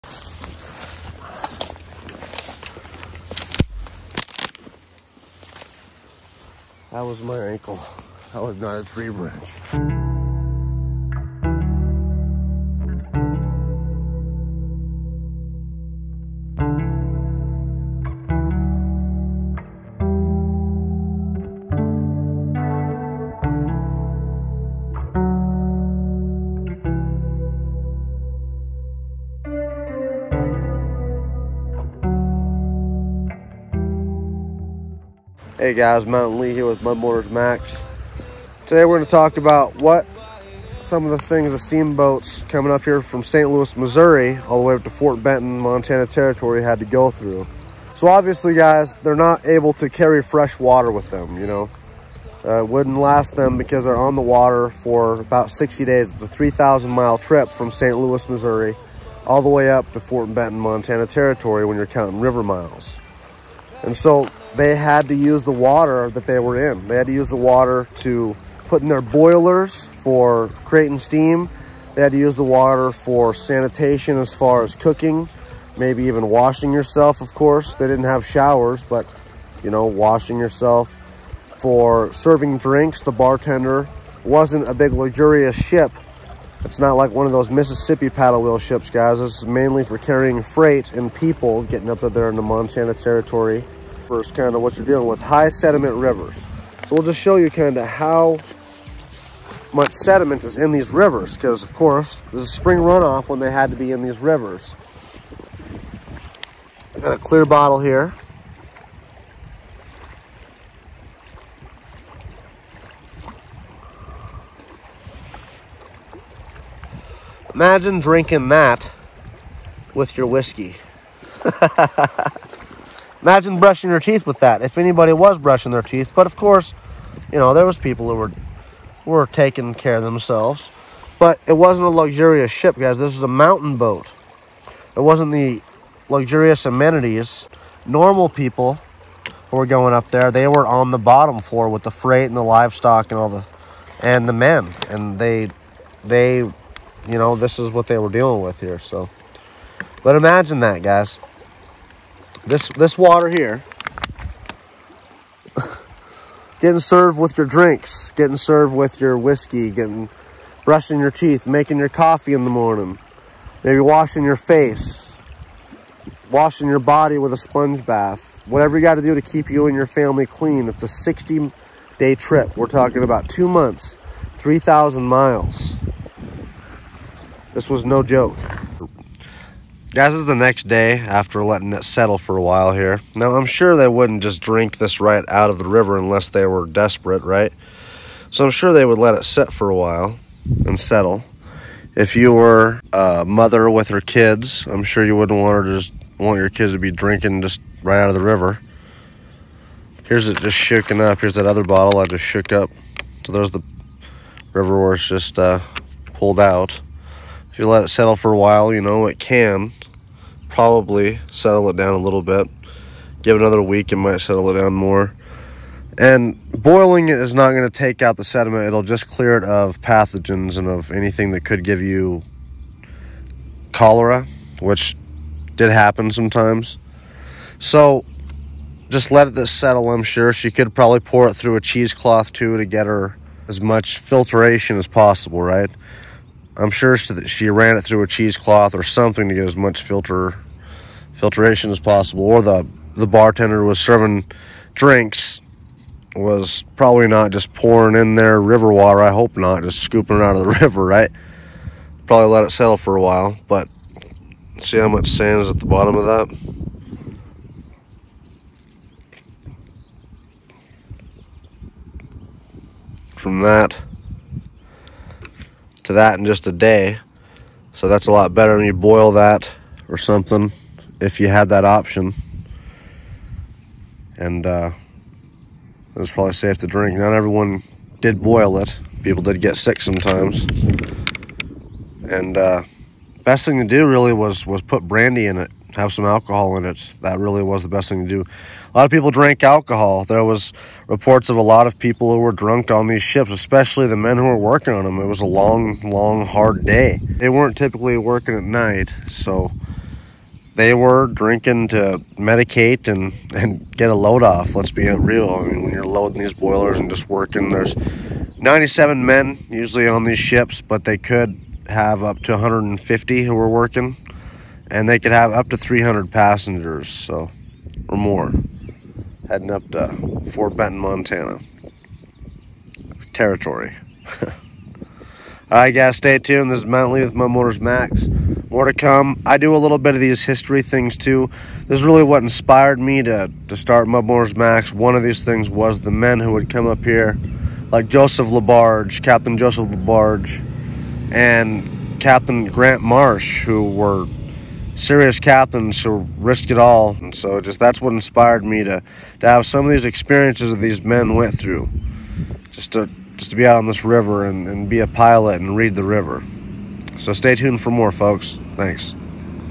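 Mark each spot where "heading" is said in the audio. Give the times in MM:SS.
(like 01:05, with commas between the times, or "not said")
05:19.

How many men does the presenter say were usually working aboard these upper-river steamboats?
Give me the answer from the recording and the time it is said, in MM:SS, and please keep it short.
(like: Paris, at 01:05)
97, at 05:08.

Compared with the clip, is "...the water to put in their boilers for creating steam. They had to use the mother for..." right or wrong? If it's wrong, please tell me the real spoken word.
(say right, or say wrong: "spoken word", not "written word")
wrong: "water", not "mother".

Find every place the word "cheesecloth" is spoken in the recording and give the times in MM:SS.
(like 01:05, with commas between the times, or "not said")
03:51, 03:58.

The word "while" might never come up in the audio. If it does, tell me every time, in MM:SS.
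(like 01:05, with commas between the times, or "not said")
03:02, 03:09, 03:28, 04:13.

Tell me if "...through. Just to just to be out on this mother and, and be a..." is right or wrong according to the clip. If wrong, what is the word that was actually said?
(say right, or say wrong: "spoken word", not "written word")
wrong: "river", not "mother".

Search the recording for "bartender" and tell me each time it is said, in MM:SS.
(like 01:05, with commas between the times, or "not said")
01:23, 04:03.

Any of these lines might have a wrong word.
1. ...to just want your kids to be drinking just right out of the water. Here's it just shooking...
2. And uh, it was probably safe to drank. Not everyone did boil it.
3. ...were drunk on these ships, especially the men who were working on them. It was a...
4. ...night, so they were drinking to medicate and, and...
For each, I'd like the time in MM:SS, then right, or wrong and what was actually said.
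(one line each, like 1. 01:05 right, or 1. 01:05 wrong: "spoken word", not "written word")
1. 03:15 wrong: "river", not "water"
2. 04:34 wrong: "drink", not "drank"
3. 04:52 right
4. 04:58 right.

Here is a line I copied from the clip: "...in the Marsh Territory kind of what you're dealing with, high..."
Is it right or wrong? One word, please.
wrong.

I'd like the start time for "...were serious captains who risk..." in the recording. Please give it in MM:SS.
05:43.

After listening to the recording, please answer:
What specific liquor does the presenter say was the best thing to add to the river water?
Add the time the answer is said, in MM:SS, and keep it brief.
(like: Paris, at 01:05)
brandy, at 04:44.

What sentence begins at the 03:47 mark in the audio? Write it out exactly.
So just let this settle, I'm sure.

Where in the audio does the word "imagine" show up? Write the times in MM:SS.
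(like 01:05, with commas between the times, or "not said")
01:57, 02:03, 02:30.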